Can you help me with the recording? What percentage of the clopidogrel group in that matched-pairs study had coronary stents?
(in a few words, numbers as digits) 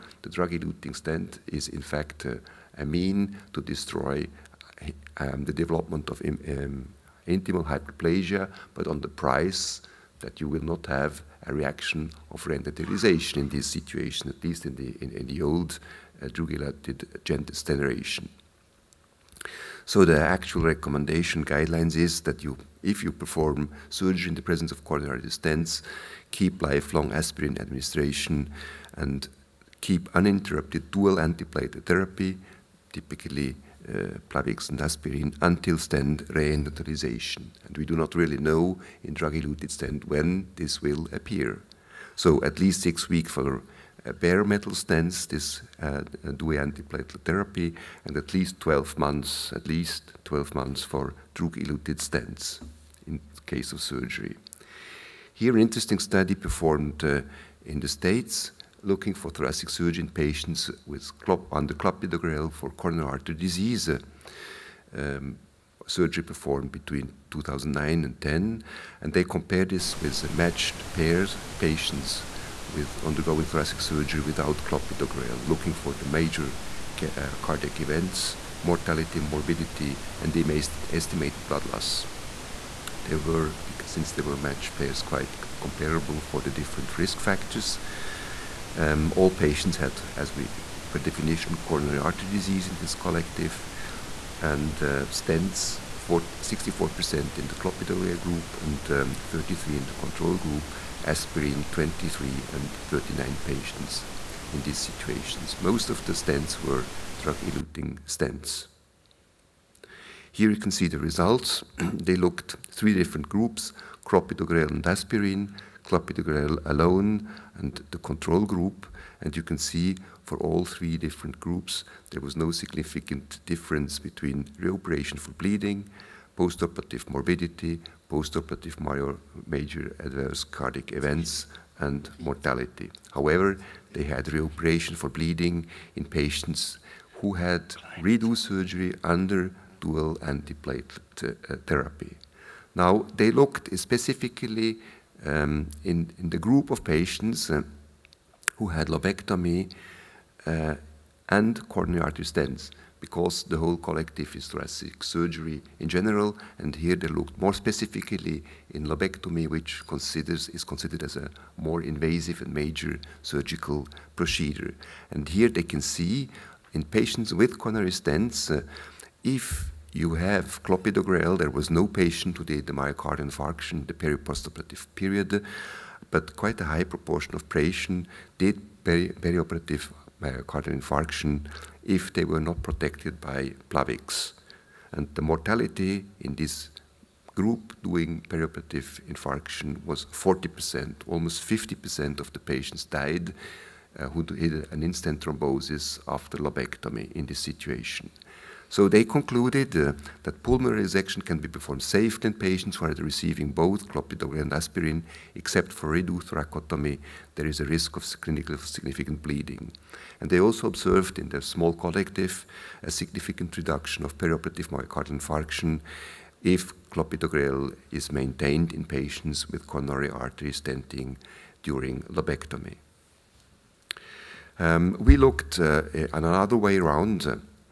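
64%.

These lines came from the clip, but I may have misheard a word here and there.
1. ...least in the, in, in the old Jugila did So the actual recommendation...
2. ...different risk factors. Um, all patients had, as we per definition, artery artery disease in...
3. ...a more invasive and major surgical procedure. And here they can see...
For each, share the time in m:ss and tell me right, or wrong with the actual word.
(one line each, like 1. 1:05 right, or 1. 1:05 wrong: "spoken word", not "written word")
1. 0:14 right
2. 1:26 wrong: "coronary", not "artery"
3. 2:41 right.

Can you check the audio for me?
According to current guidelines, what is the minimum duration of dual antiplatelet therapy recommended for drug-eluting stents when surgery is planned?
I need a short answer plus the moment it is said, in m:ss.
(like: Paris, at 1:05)
12 months, at 0:49.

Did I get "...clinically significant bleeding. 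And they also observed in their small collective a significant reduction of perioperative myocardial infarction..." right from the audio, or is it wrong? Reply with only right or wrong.
right.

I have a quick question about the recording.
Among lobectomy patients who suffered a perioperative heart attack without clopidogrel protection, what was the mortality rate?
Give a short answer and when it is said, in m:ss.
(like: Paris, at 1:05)
40%, at 3:10.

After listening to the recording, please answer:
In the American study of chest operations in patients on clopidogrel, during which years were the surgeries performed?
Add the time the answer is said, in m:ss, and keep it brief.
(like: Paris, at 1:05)
2009 and 2010, at 1:06.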